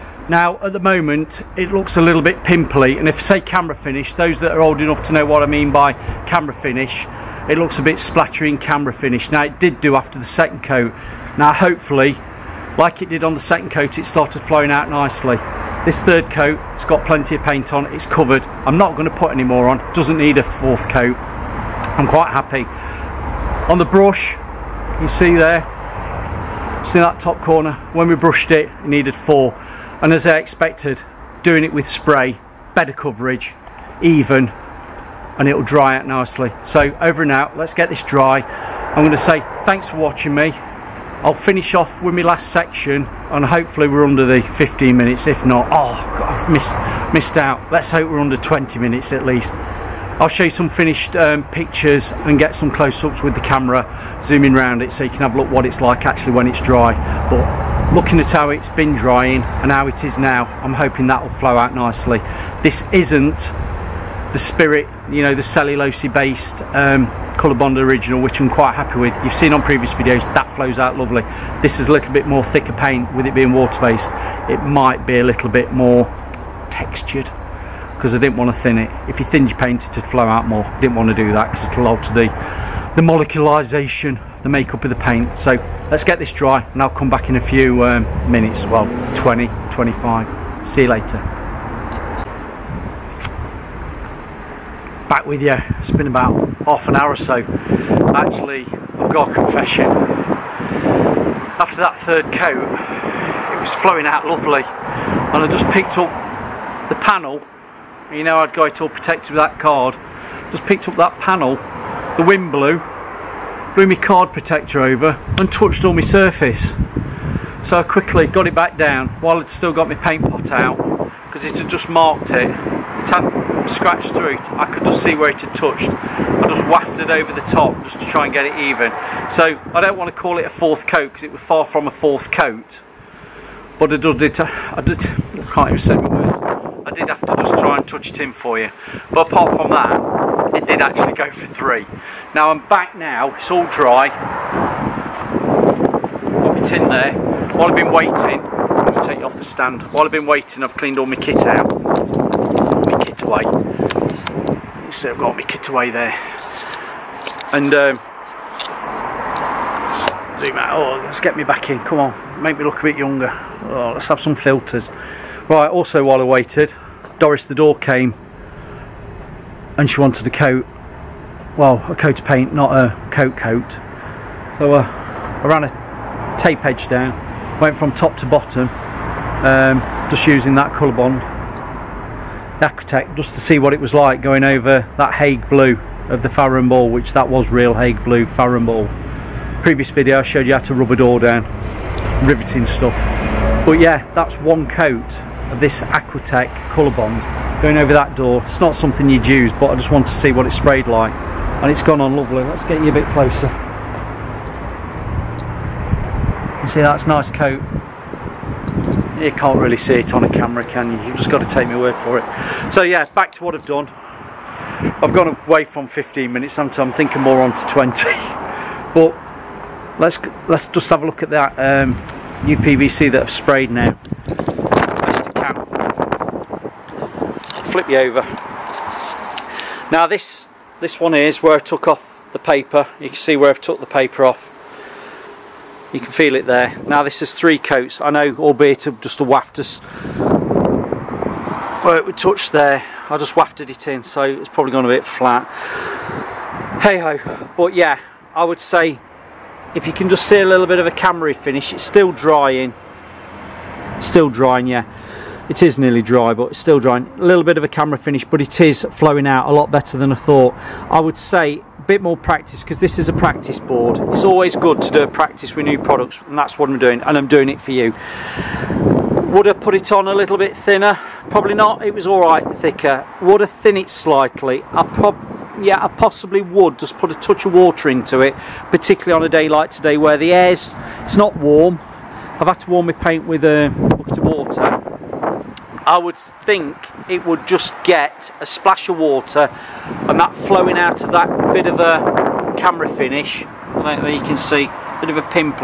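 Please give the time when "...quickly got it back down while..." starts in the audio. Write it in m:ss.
1:57.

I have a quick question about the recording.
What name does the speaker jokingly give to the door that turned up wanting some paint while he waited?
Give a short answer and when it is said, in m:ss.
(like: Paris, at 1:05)
Doris, at 2:47.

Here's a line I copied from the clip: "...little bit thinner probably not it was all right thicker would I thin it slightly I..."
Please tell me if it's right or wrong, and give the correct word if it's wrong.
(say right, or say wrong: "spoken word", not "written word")
right.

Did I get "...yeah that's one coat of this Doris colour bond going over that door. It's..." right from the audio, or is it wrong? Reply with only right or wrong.
wrong.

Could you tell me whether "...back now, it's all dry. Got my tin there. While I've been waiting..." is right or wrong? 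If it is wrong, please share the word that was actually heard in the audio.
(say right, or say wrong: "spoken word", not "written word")
right.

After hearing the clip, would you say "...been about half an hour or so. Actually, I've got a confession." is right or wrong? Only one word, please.
right.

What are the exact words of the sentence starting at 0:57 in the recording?
But looking at how it's been drying and how it is now, I'm hoping that will flow out nicely.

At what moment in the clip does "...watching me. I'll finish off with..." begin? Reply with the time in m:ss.
0:39.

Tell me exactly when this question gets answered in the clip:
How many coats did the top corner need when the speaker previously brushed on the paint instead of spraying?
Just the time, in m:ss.
0:29.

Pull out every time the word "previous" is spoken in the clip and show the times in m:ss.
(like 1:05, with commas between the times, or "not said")
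1:09, 3:09.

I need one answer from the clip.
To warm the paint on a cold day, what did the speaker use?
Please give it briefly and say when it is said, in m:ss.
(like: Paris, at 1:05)
a bucket of water, at 4:43.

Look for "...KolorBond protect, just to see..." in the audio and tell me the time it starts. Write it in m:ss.
3:00.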